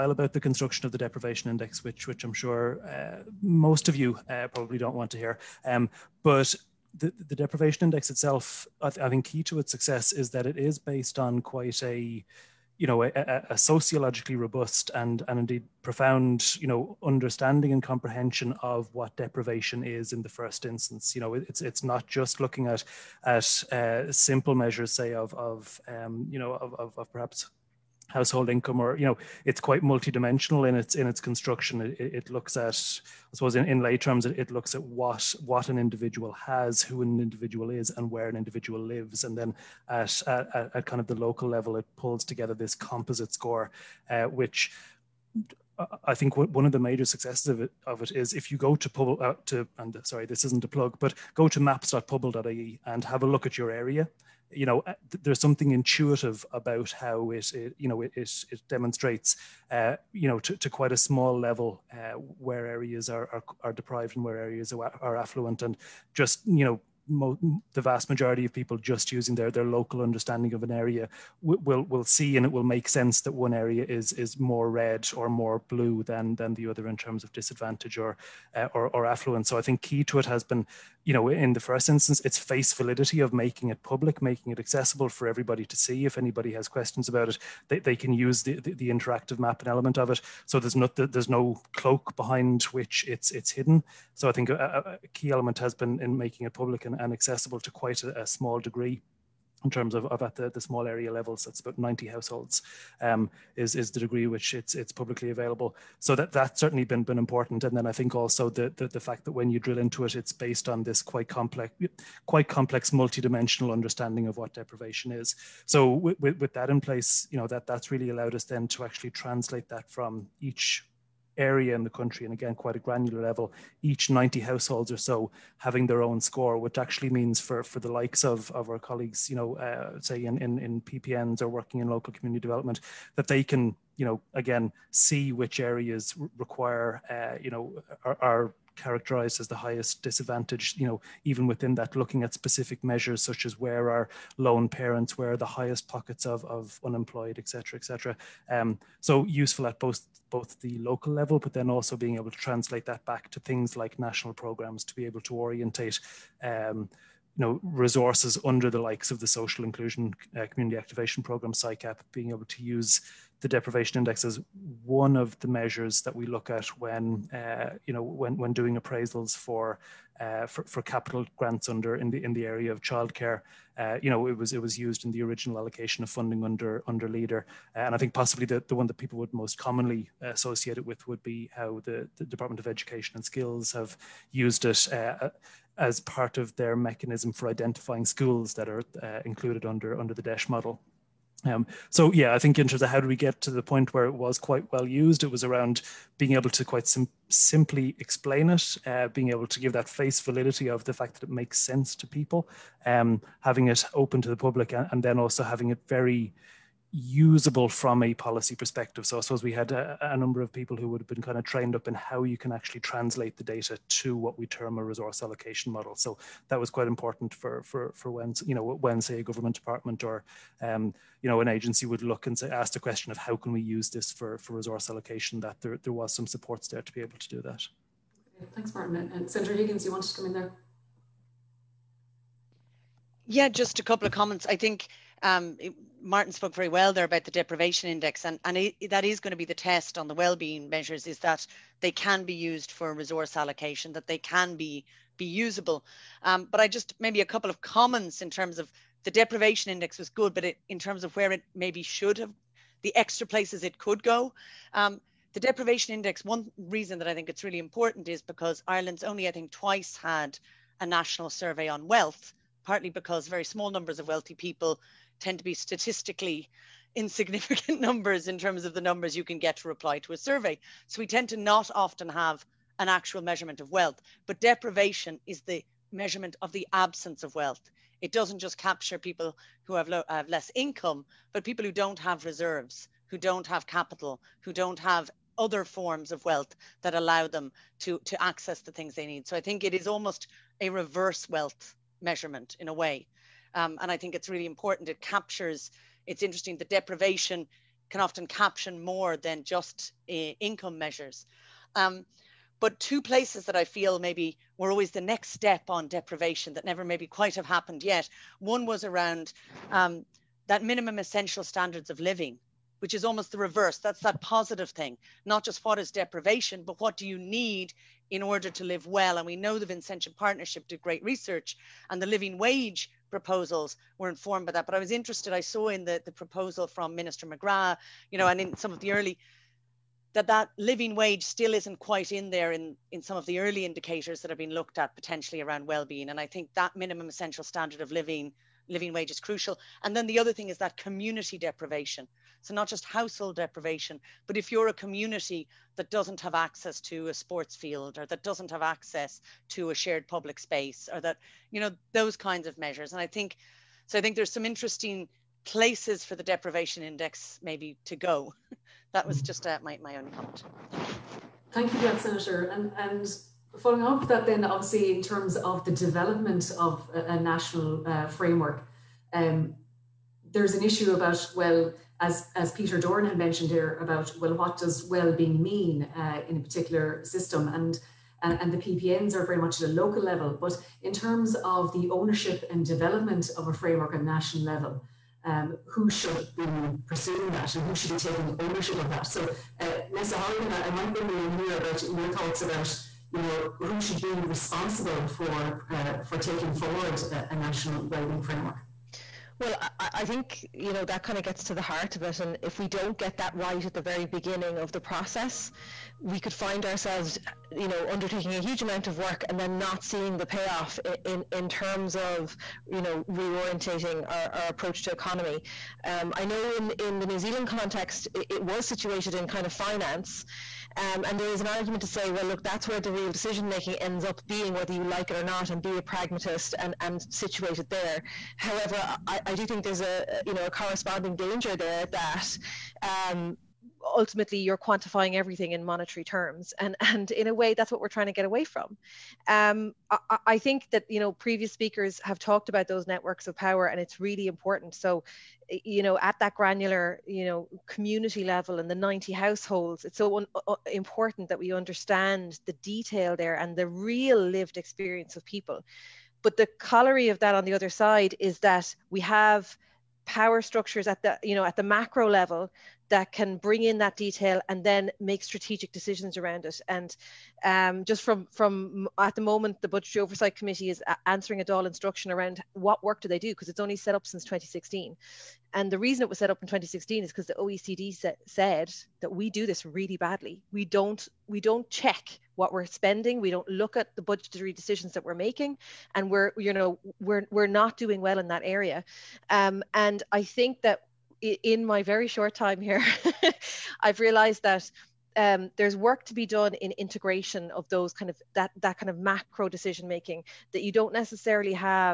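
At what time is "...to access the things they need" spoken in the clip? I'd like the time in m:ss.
4:48.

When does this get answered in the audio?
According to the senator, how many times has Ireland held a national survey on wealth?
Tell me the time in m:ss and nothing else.
4:19.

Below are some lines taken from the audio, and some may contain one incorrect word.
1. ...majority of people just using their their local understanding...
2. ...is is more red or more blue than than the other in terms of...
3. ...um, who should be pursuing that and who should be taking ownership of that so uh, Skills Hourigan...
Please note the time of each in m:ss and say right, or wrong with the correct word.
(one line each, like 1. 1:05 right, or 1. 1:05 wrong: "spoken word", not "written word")
1. 1:08 right
2. 1:13 right
3. 6:25 wrong: "Neasa", not "Skills".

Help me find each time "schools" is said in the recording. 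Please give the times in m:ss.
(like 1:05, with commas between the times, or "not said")
3:08.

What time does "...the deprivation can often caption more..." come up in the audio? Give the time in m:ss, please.
4:56.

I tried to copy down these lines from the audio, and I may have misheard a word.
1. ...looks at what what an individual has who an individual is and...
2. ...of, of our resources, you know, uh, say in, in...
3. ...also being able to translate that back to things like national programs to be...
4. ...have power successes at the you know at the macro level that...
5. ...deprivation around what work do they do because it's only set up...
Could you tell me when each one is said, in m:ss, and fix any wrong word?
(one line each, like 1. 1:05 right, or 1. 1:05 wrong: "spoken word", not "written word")
1. 0:34 right
2. 2:08 wrong: "colleagues", not "resources"
3. 2:31 right
4. 7:38 wrong: "structures", not "successes"
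5. 7:51 wrong: "instruction", not "deprivation".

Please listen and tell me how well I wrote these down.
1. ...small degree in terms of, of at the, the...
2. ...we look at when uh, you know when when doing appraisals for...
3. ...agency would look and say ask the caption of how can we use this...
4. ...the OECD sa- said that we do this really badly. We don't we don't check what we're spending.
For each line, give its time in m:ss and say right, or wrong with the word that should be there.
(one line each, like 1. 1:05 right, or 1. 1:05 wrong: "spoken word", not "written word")
1. 1:38 right
2. 2:46 right
3. 3:41 wrong: "question", not "caption"
4. 7:57 right.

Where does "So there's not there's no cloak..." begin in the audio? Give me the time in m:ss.
1:30.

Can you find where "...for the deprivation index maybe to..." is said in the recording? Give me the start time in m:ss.
5:56.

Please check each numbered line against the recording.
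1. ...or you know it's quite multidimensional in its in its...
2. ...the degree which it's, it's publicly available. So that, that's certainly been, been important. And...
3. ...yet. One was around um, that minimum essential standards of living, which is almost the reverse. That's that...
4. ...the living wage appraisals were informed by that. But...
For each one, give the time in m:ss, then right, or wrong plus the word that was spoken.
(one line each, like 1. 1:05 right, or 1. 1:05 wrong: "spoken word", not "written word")
1. 0:28 right
2. 1:43 right
3. 5:07 right
4. 5:21 wrong: "proposals", not "appraisals".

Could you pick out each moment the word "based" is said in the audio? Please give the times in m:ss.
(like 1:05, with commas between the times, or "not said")
0:10, 1:50.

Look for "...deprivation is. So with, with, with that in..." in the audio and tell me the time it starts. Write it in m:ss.
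1:54.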